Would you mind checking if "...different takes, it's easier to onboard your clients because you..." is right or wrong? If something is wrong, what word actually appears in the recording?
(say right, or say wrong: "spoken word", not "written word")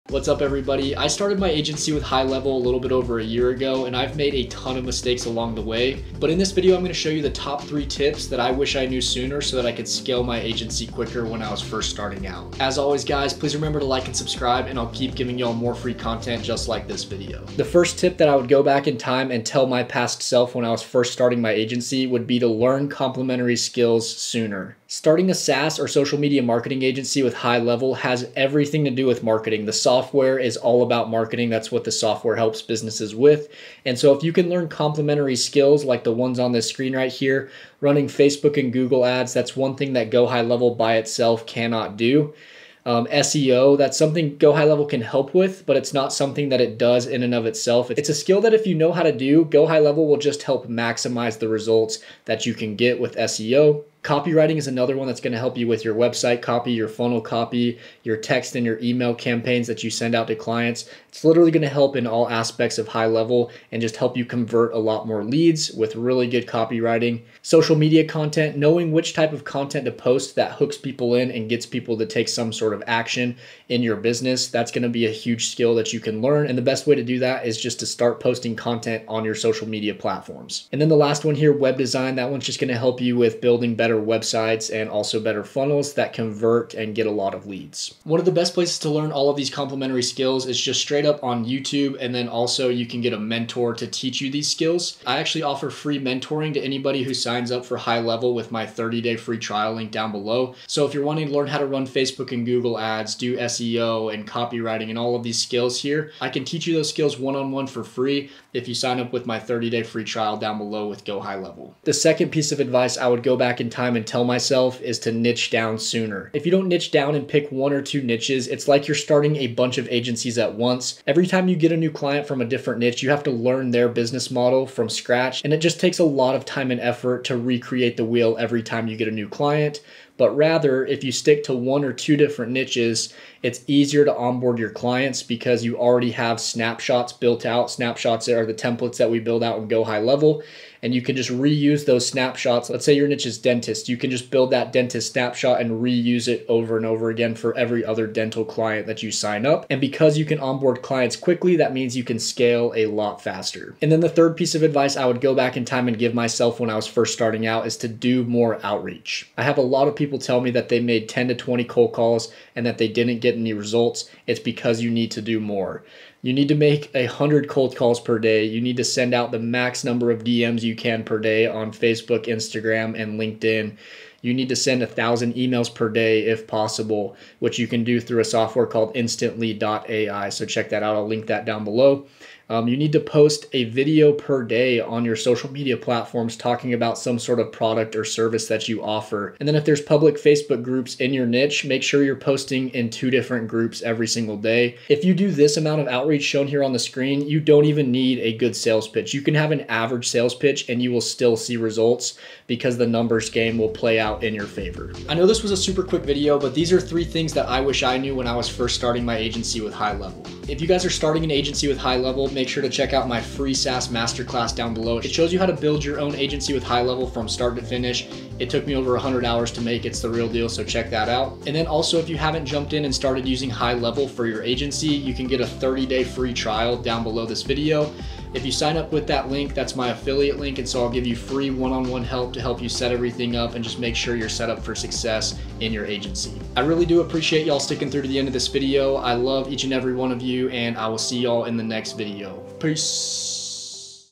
wrong: "niches", not "takes".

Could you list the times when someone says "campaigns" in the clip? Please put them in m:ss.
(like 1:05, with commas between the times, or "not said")
0:59.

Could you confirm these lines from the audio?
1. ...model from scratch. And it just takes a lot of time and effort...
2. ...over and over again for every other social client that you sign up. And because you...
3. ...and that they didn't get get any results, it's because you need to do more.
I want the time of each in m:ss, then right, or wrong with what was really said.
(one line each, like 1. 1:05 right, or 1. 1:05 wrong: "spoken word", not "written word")
1. 2:04 right
2. 2:26 wrong: "dental", not "social"
3. 2:42 right.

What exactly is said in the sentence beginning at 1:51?
The second piece of advice I would go back in time time and tell myself is to niche down sooner.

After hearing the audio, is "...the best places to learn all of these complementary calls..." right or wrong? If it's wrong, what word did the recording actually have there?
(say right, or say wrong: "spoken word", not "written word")
wrong: "skills", not "calls".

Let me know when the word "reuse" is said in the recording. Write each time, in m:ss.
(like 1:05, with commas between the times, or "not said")
2:21, 2:25.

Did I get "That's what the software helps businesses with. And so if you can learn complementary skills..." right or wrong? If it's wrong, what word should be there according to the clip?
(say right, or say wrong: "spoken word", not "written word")
right.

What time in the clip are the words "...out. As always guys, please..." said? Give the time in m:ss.
0:12.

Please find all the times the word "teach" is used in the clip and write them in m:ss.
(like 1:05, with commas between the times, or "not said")
1:33, 1:46.